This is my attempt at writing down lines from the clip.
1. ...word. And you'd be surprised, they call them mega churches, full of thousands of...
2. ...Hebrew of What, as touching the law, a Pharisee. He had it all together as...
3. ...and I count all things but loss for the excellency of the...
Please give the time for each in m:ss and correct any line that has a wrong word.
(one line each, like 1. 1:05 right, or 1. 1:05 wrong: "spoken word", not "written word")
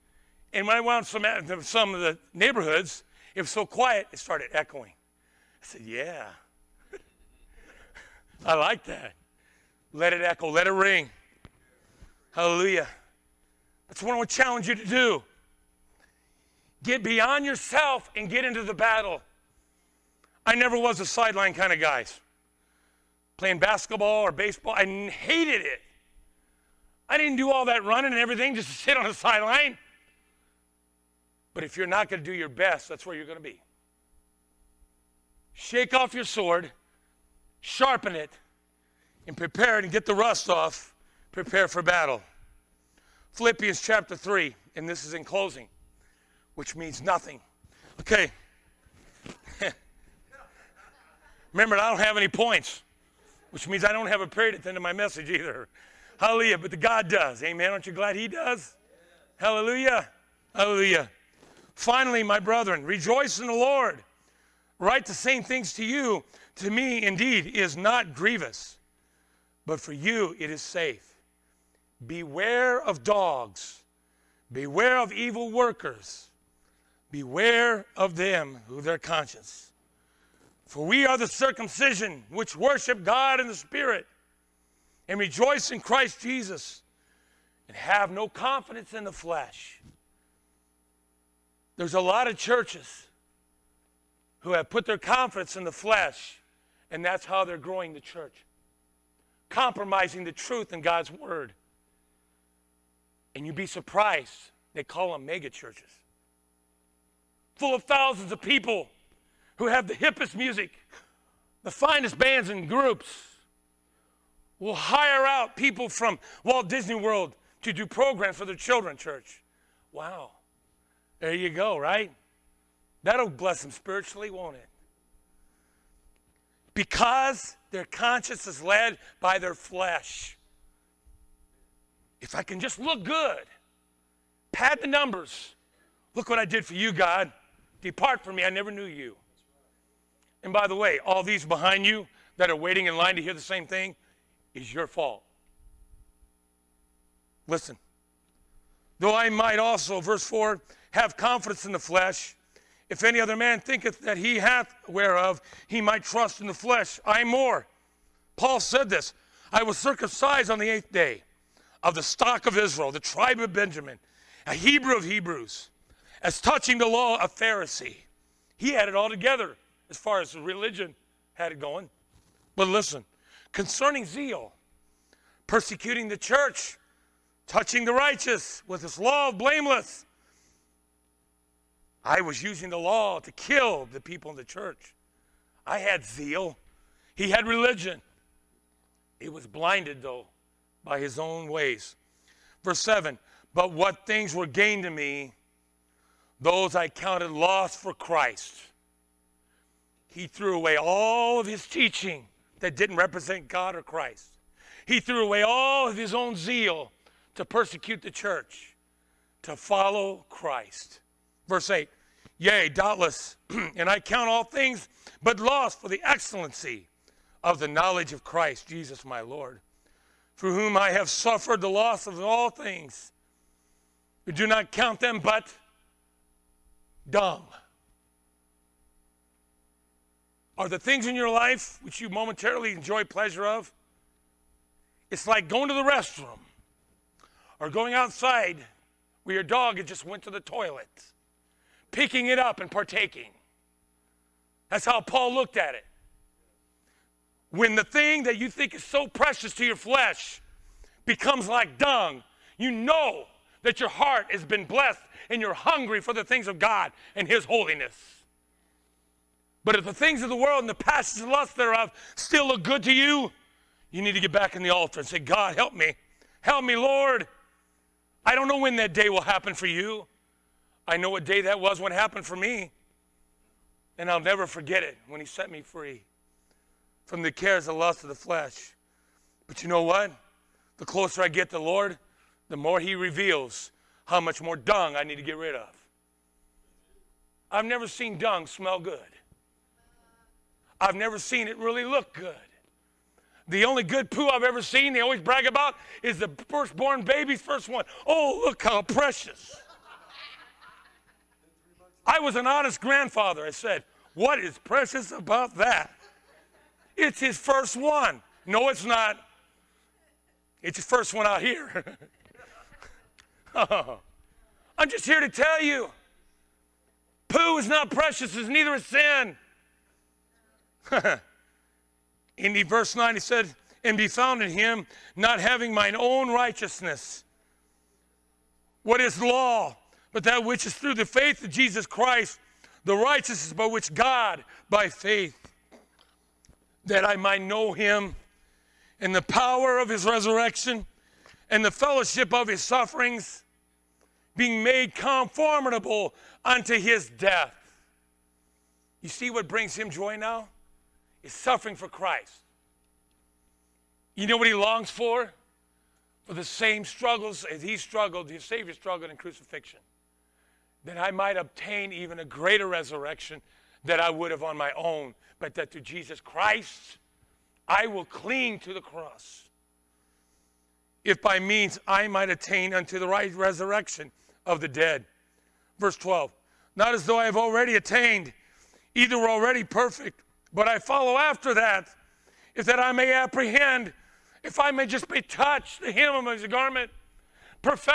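1. 1:41 right
2. 2:44 wrong: "Hebrews", not "What"
3. 3:33 right.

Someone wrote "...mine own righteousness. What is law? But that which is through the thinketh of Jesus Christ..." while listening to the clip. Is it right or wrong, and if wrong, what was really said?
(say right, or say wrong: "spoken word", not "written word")
wrong: "faith", not "thinketh".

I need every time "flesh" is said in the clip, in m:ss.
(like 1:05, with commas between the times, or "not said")
1:29, 1:35, 2:09, 2:31, 2:36, 4:09, 4:38.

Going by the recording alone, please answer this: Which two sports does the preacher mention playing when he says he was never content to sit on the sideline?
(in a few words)
Basketball or baseball.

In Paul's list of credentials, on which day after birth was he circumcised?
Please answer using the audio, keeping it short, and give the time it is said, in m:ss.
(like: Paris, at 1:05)
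The 8th day, at 2:40.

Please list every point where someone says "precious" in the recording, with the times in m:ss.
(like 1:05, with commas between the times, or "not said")
4:09, 4:58, 5:04, 5:17.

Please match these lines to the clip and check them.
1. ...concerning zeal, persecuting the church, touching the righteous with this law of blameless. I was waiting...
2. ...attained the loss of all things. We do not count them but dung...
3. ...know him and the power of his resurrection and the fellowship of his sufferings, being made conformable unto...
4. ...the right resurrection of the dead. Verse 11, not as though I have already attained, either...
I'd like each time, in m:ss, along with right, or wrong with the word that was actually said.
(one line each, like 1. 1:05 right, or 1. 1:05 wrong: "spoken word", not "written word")
1. 2:53 wrong: "using", not "waiting"
2. 3:41 wrong: "suffered", not "attained"
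3. 5:37 right
4. 6:12 wrong: "12", not "11".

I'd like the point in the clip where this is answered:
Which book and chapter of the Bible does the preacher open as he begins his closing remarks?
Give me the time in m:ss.
0:43.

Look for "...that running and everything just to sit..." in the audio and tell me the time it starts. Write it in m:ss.
0:27.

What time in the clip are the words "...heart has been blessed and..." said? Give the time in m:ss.
4:13.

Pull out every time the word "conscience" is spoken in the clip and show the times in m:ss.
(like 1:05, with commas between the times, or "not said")
1:18, 2:07.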